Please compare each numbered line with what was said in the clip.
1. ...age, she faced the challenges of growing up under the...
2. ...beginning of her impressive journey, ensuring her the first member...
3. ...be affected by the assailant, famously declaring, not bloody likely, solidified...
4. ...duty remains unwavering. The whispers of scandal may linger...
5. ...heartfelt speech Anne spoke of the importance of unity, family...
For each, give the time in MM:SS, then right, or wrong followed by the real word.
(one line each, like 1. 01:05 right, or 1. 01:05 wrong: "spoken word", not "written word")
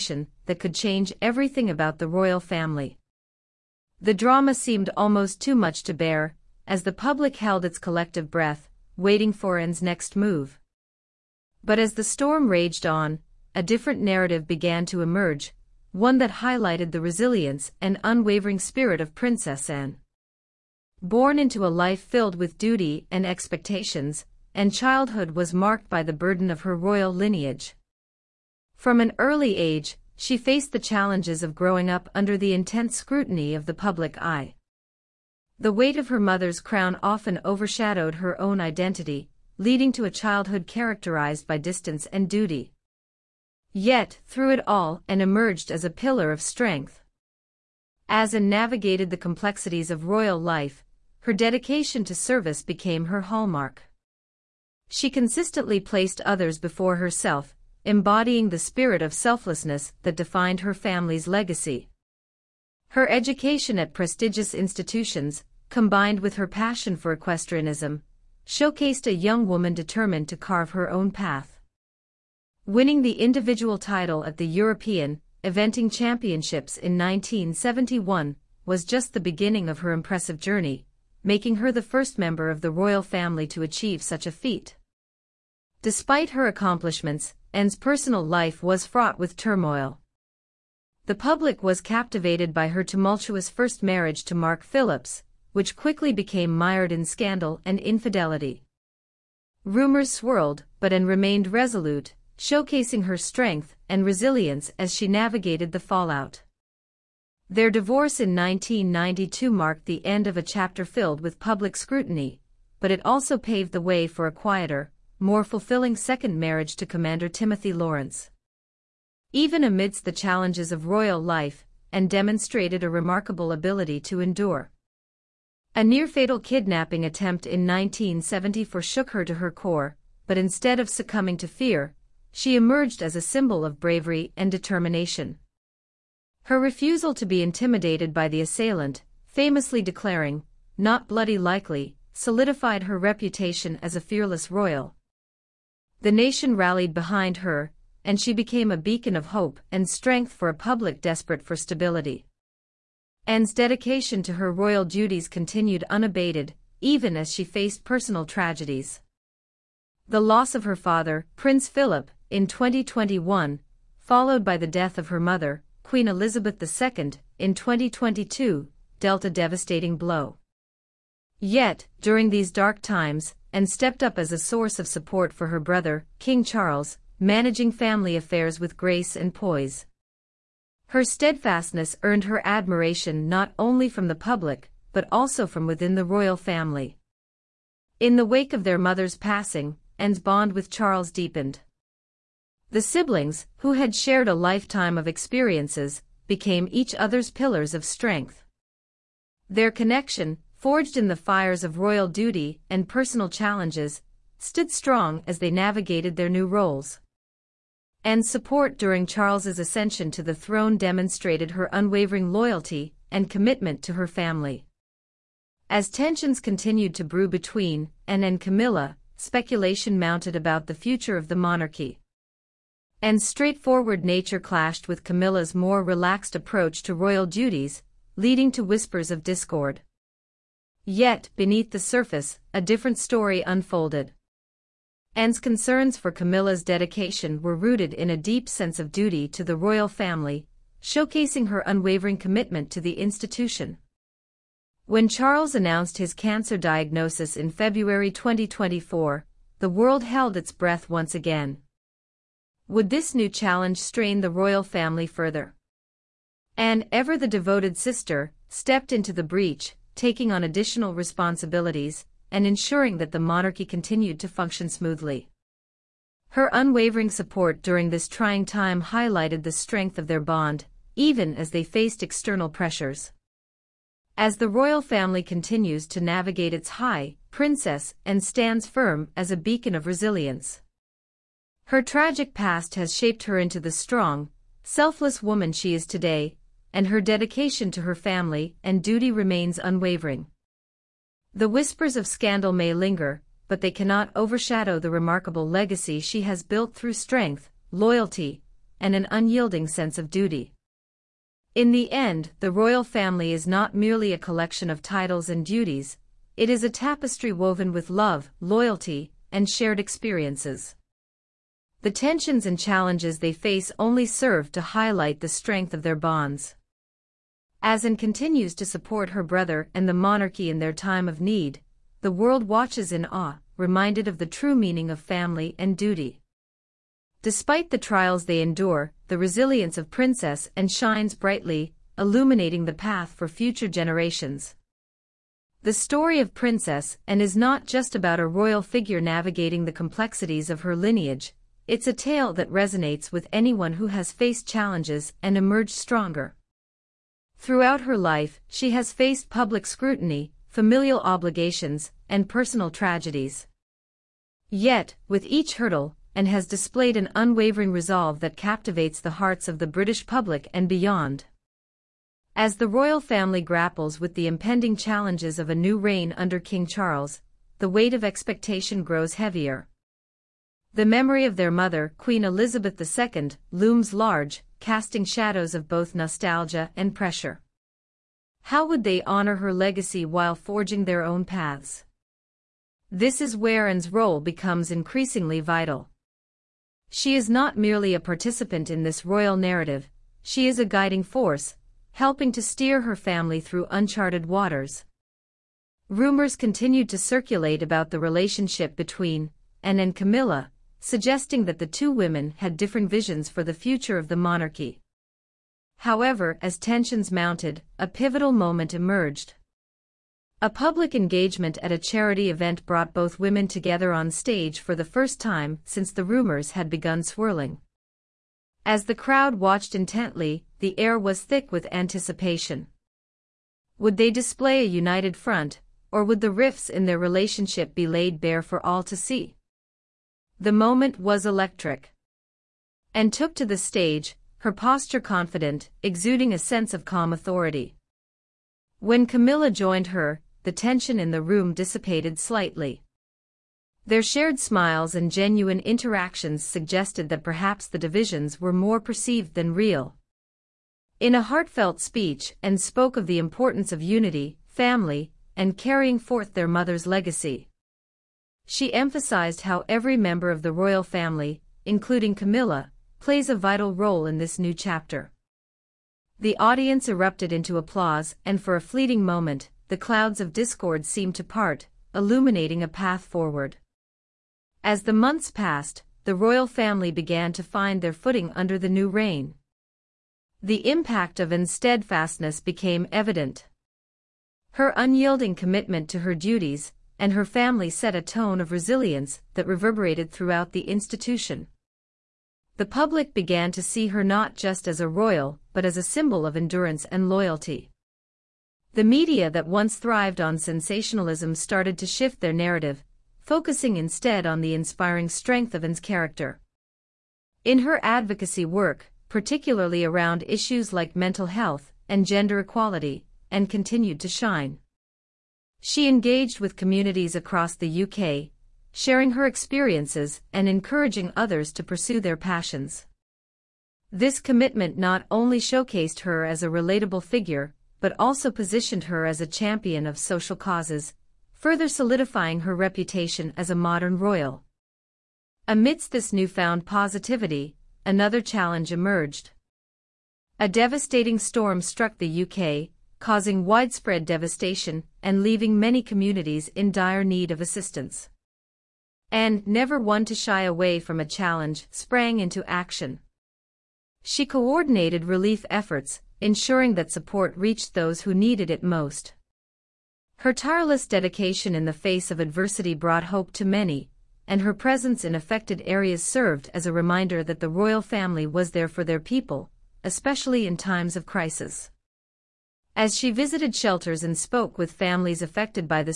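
1. 00:29 right
2. 01:19 wrong: "making", not "ensuring"
3. 02:17 wrong: "intimidated", not "affected"
4. 04:48 right
5. 07:31 right.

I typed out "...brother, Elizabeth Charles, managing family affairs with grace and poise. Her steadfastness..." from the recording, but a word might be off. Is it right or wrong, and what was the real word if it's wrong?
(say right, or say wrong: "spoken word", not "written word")
wrong: "King", not "Elizabeth".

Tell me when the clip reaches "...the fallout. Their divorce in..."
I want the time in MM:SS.
01:45.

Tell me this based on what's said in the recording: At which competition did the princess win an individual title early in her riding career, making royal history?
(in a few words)
European Eventing Championships.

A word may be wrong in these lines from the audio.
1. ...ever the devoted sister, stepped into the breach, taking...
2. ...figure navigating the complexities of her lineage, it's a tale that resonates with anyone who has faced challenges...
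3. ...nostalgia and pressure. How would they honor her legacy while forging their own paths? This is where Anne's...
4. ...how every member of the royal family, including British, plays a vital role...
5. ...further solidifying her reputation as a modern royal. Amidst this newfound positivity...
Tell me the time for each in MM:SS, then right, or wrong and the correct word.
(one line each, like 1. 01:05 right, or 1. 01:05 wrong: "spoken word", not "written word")
1. 04:16 right
2. 05:38 right
3. 06:15 right
4. 07:39 wrong: "Camilla", not "British"
5. 08:51 right.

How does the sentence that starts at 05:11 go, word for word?
The tensions and challenges they face only serve to highlight the strength of their bonds.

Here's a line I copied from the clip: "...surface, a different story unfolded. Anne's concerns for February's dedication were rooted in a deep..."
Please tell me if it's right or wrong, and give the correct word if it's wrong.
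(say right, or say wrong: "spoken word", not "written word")
wrong: "Camilla", not "February".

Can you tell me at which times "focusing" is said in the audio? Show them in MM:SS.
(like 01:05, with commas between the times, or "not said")
08:23.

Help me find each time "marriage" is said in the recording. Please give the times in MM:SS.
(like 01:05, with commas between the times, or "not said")
01:33, 01:56.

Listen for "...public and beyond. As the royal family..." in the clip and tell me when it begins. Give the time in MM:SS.
06:00.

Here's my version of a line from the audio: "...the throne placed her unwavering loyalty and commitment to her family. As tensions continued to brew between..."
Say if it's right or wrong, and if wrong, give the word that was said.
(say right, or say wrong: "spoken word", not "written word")
wrong: "demonstrated", not "placed".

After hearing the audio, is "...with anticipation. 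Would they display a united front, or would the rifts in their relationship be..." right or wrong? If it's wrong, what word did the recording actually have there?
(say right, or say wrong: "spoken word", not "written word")
right.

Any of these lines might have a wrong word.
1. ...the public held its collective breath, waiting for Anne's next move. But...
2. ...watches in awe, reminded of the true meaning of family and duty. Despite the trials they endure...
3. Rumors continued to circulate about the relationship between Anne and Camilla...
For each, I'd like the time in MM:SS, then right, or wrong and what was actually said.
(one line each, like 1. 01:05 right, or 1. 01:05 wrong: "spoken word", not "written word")
1. 00:06 right
2. 05:22 right
3. 06:35 right.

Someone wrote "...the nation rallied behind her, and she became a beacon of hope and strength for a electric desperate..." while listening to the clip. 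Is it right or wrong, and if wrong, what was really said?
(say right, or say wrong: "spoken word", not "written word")
wrong: "public", not "electric".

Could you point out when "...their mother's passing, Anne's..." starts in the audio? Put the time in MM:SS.
03:08.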